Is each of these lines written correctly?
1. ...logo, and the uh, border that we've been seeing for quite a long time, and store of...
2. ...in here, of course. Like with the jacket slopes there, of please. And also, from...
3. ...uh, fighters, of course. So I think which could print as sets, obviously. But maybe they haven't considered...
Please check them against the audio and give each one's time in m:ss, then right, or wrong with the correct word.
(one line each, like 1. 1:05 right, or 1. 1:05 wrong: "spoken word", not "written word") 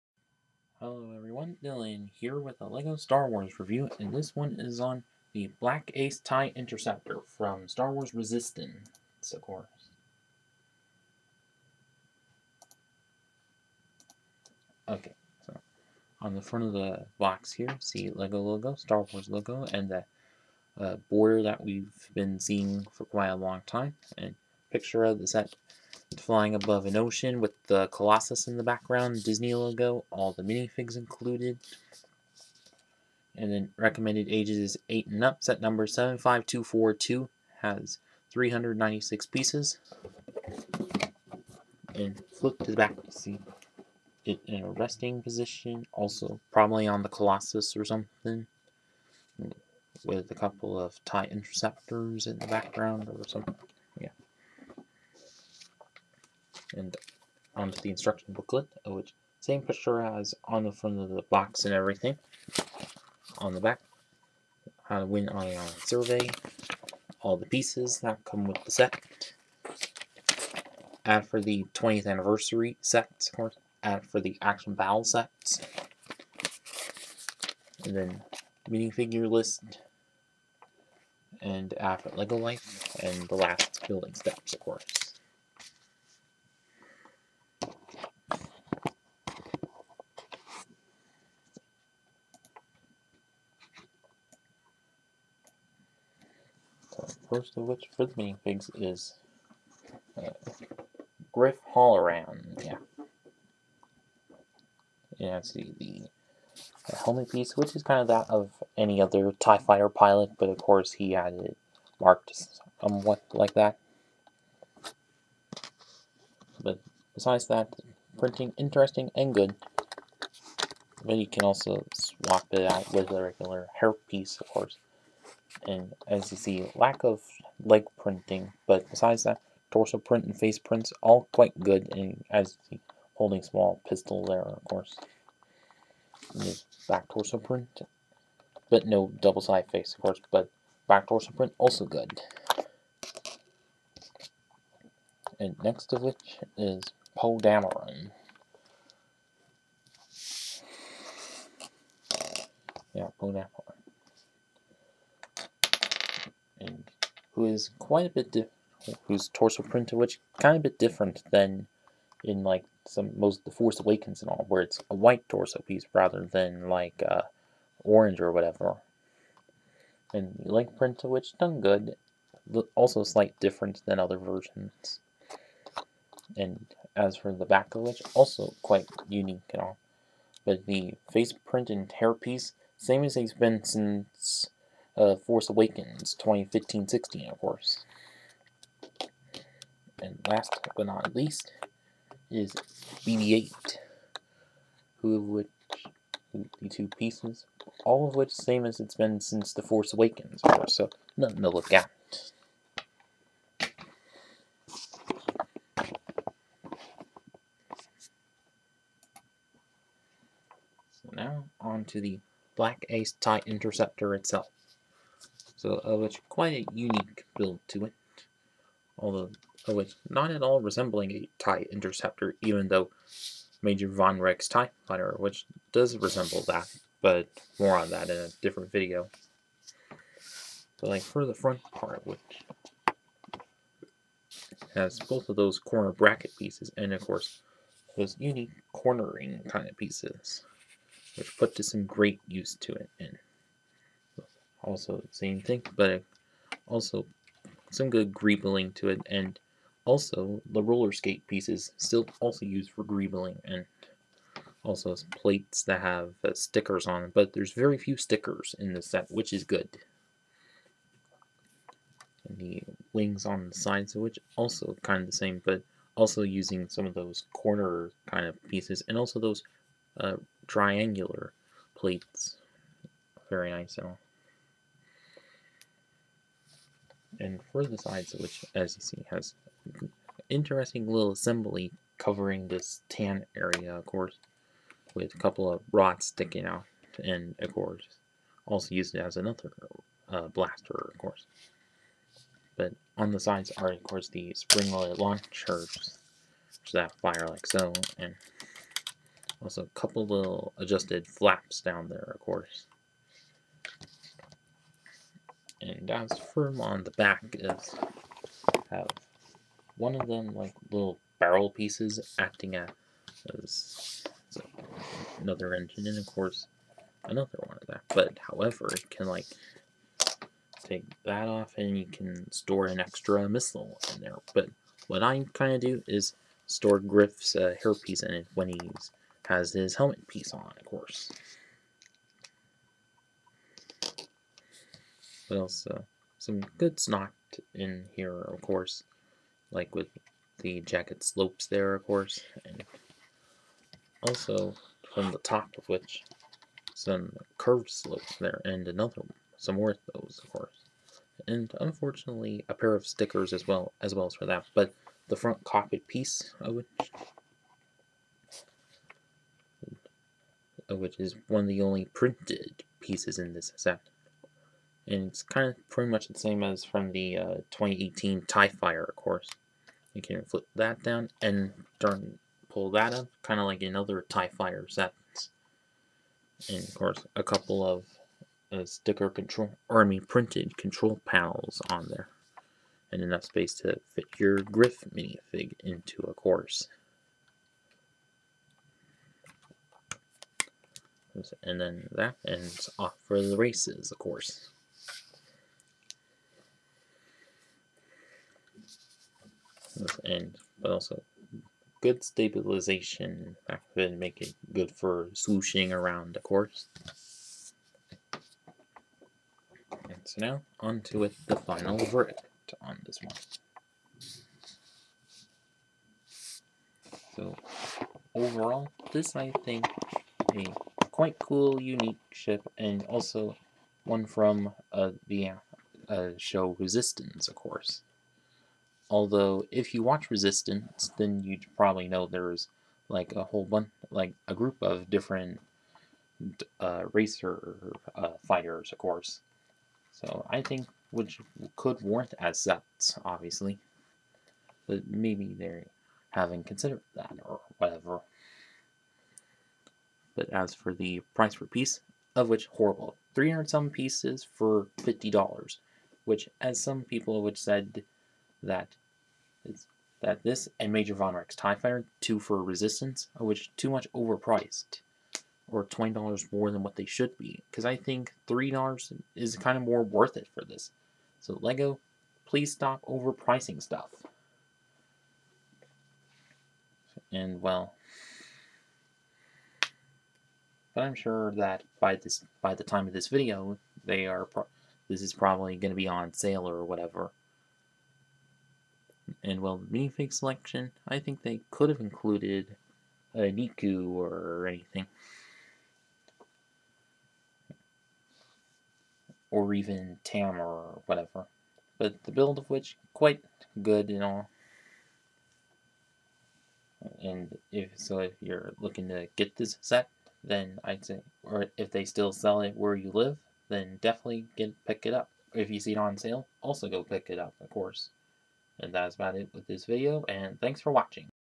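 1. 0:19 wrong: "picture", not "store"
2. 5:37 wrong: "course", not "please"
3. 7:17 wrong: "warrant", not "print".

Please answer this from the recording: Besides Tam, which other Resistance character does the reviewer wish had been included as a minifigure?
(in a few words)
Neeku.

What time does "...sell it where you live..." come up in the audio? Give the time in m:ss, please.
8:32.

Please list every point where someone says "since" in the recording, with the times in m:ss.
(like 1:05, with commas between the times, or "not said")
3:03, 3:19.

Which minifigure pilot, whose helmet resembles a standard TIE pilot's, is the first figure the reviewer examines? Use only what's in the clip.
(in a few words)
Griff Halloran.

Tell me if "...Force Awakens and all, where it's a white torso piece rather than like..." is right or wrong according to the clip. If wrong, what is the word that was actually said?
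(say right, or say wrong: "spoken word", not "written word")
right.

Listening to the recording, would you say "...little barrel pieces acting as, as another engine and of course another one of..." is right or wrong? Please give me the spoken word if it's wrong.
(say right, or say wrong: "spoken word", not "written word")
right.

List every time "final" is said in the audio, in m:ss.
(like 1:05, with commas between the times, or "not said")
6:51.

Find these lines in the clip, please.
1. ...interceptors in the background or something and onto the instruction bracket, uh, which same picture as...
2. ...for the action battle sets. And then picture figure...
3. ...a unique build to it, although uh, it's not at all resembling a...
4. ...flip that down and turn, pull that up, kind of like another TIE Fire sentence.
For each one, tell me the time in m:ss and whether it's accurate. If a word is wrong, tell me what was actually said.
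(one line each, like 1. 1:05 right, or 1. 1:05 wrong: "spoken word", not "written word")
1. 0:51 wrong: "booklet", not "bracket"
2. 1:14 wrong: "minifigure", not "picture"
3. 3:36 right
4. 6:10 right.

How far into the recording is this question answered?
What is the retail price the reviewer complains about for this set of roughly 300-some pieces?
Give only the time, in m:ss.
7:34.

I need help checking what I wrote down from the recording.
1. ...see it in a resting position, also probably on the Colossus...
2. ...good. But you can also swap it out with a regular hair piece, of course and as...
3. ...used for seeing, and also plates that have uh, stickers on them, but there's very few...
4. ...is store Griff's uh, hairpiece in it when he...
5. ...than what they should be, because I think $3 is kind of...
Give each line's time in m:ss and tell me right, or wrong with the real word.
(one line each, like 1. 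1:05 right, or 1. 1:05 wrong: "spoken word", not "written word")
1. 0:43 right
2. 1:59 right
3. 4:12 wrong: "greebling", not "seeing"
4. 5:25 right
5. 7:46 right.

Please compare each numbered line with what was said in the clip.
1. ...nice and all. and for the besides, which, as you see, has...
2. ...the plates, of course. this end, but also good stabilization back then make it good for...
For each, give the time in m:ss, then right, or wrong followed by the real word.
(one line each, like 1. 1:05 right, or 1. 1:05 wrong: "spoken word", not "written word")
1. 4:33 wrong: "sides", not "besides"
2. 6:33 wrong: "races", not "plates".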